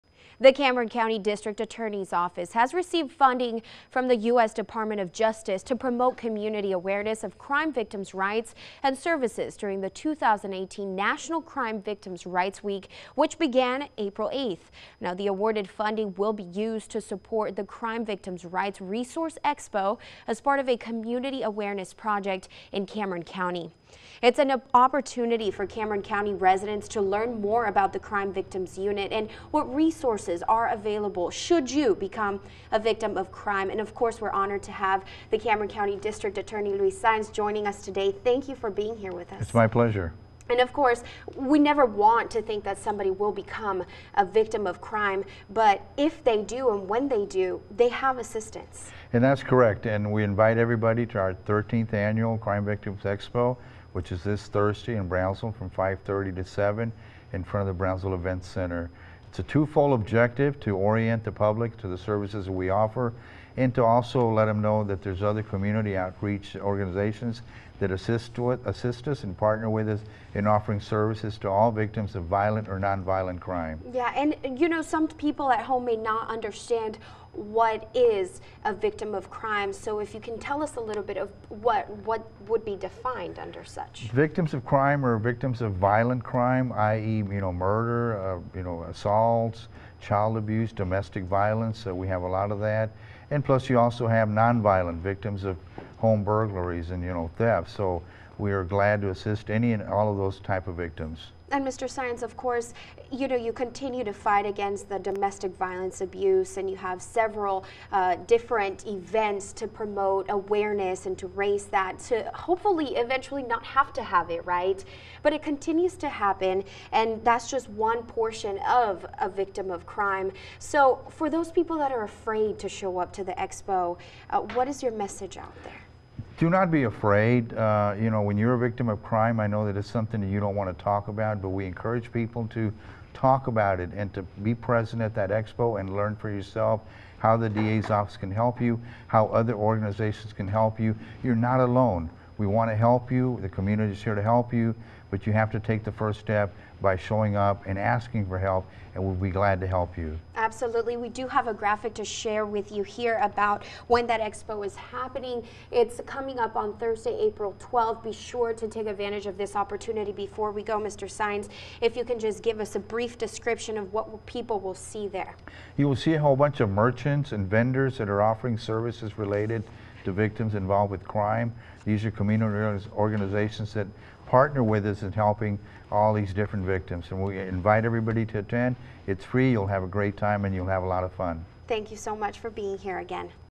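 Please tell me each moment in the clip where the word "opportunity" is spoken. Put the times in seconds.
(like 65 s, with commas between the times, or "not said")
24 s, 159 s.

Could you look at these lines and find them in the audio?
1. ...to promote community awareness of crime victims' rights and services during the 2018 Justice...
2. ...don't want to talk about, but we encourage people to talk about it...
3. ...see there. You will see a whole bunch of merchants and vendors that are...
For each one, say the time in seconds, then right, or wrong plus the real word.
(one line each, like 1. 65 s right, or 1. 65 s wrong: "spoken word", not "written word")
1. 5 s wrong: "National", not "Justice"
2. 130 s right
3. 164 s right.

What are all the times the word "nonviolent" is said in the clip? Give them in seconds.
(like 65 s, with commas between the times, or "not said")
72 s, 94 s.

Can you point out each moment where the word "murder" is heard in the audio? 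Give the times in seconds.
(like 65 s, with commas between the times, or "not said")
87 s.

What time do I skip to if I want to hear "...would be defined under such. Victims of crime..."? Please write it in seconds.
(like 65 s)
82 s.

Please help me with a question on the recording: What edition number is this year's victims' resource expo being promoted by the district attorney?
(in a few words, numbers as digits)
13th.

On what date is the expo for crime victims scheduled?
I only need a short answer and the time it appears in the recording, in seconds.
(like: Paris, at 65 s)
April 12th, at 157 s.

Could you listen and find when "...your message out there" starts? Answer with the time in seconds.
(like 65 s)
124 s.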